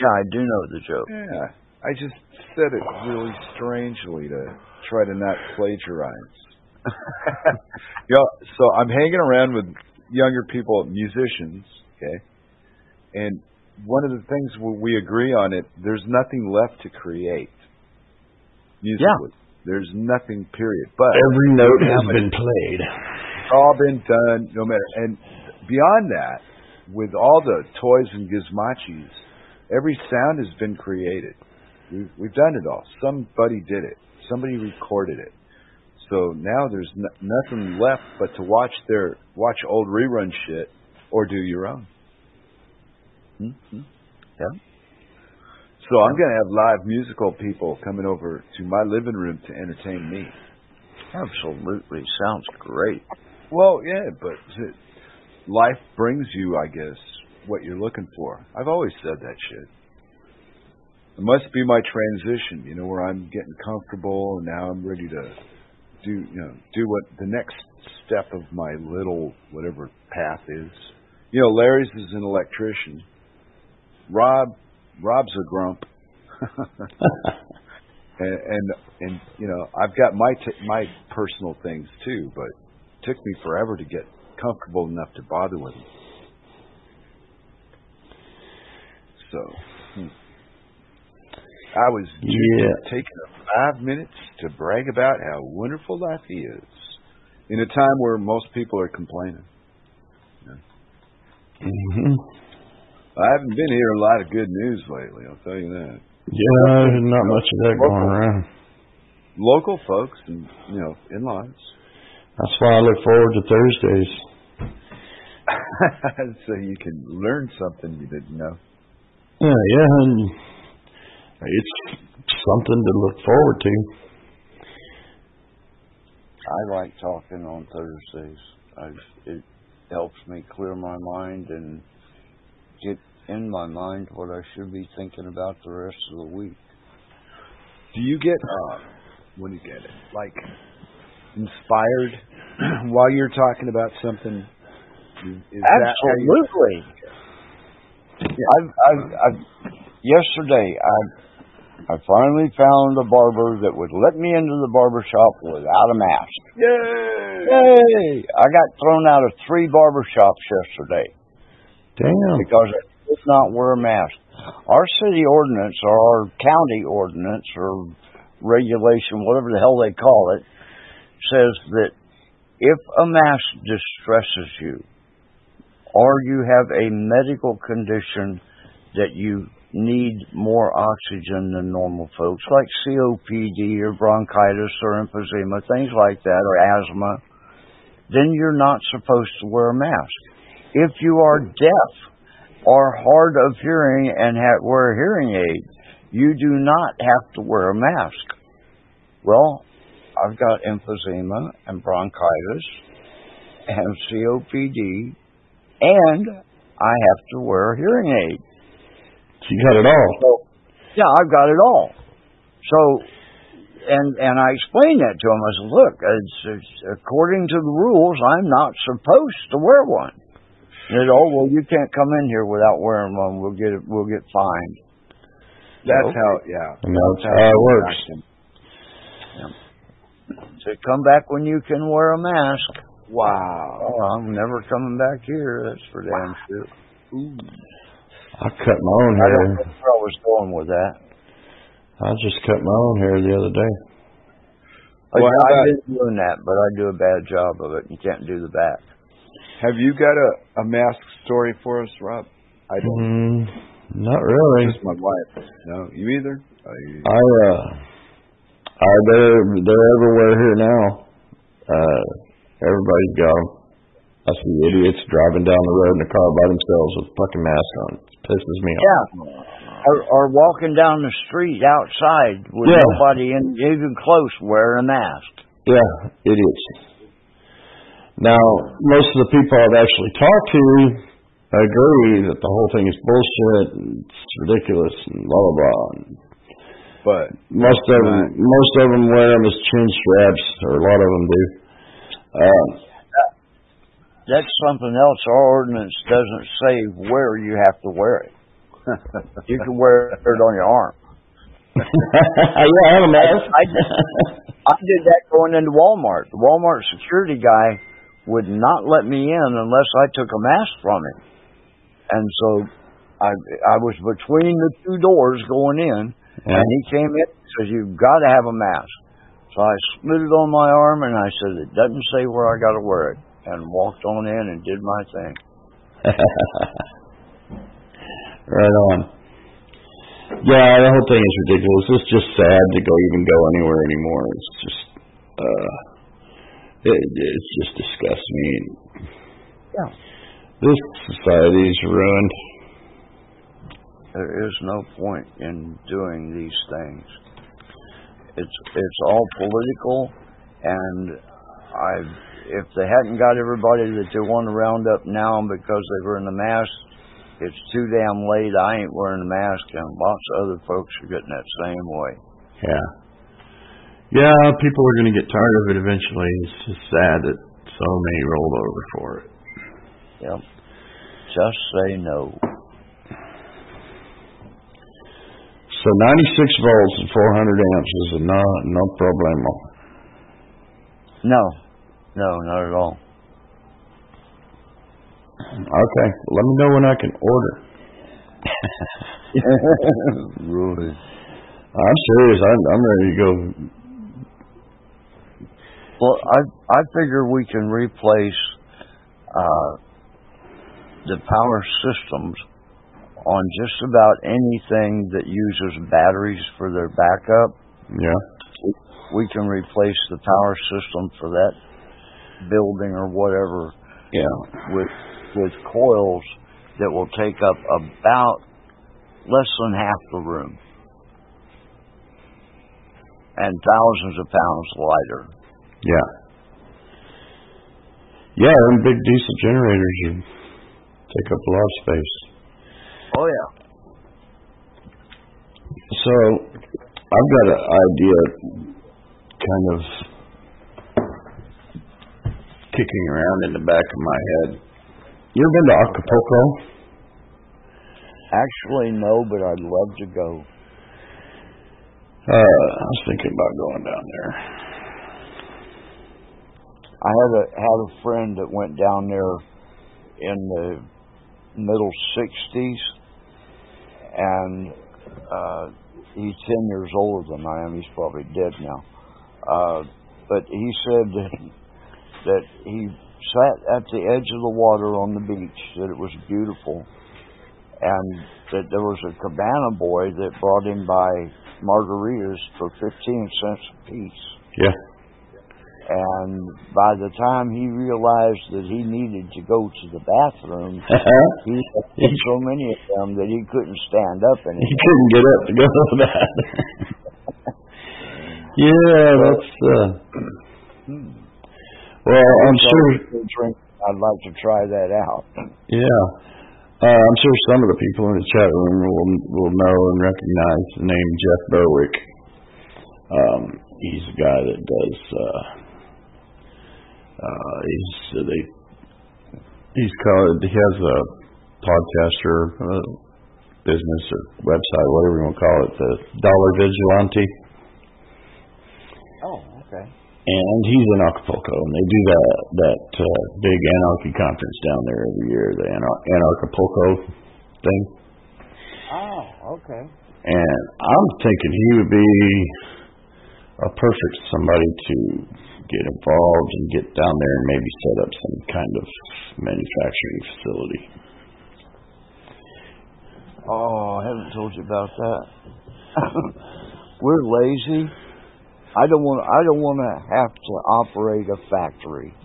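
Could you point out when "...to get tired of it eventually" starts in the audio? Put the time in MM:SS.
06:05.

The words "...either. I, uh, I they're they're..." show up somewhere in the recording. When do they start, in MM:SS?
04:16.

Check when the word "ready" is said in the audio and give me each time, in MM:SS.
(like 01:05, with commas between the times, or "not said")
01:04, 06:32.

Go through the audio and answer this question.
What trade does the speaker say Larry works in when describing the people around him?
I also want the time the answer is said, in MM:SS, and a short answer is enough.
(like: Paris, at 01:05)
electrician, at 01:12.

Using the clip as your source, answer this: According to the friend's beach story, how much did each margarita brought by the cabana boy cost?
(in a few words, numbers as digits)
15 cents.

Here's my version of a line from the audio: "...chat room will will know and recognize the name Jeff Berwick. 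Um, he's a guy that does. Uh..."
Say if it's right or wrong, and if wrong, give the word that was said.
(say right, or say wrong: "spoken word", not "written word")
right.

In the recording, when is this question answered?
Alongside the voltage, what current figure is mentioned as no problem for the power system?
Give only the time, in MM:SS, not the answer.
06:17.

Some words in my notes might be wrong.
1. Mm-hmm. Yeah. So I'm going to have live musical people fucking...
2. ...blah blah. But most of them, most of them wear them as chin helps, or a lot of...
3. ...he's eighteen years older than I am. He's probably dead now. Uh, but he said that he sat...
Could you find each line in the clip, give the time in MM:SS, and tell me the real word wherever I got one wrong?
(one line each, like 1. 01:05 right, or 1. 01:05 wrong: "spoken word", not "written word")
1. 00:43 wrong: "coming", not "fucking"
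2. 04:45 wrong: "straps", not "helps"
3. 07:46 wrong: "ten", not "eighteen".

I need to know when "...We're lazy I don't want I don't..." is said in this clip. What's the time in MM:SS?
09:17.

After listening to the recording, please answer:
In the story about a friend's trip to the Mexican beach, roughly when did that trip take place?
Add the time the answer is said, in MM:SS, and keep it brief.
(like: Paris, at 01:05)
mid-1960s, at 07:41.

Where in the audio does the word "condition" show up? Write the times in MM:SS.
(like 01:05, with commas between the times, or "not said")
02:57.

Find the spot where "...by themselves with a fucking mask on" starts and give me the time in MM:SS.
04:26.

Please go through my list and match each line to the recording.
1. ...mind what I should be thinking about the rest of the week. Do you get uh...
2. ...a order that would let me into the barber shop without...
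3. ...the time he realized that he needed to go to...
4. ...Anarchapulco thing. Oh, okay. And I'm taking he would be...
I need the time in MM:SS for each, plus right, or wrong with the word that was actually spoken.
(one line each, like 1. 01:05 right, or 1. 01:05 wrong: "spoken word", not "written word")
1. 02:13 right
2. 02:32 wrong: "barber", not "order"
3. 08:06 right
4. 08:56 wrong: "thinking", not "taking".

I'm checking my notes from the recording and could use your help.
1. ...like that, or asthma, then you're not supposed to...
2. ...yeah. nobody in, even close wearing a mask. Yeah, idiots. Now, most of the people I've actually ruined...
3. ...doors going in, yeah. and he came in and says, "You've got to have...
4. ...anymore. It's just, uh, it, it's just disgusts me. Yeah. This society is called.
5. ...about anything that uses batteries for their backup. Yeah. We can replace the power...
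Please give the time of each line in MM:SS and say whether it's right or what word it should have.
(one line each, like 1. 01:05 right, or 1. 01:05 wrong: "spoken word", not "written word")
1. 03:05 right
2. 04:32 wrong: "talked", not "ruined"
3. 05:14 right
4. 05:33 wrong: "ruined", not "called"
5. 06:43 right.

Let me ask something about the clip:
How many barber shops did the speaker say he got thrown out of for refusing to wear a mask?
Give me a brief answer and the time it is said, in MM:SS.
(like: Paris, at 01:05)
3, at 02:39.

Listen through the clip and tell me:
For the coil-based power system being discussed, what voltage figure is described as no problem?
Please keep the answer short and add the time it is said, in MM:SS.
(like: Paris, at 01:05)
96 volts, at 06:16.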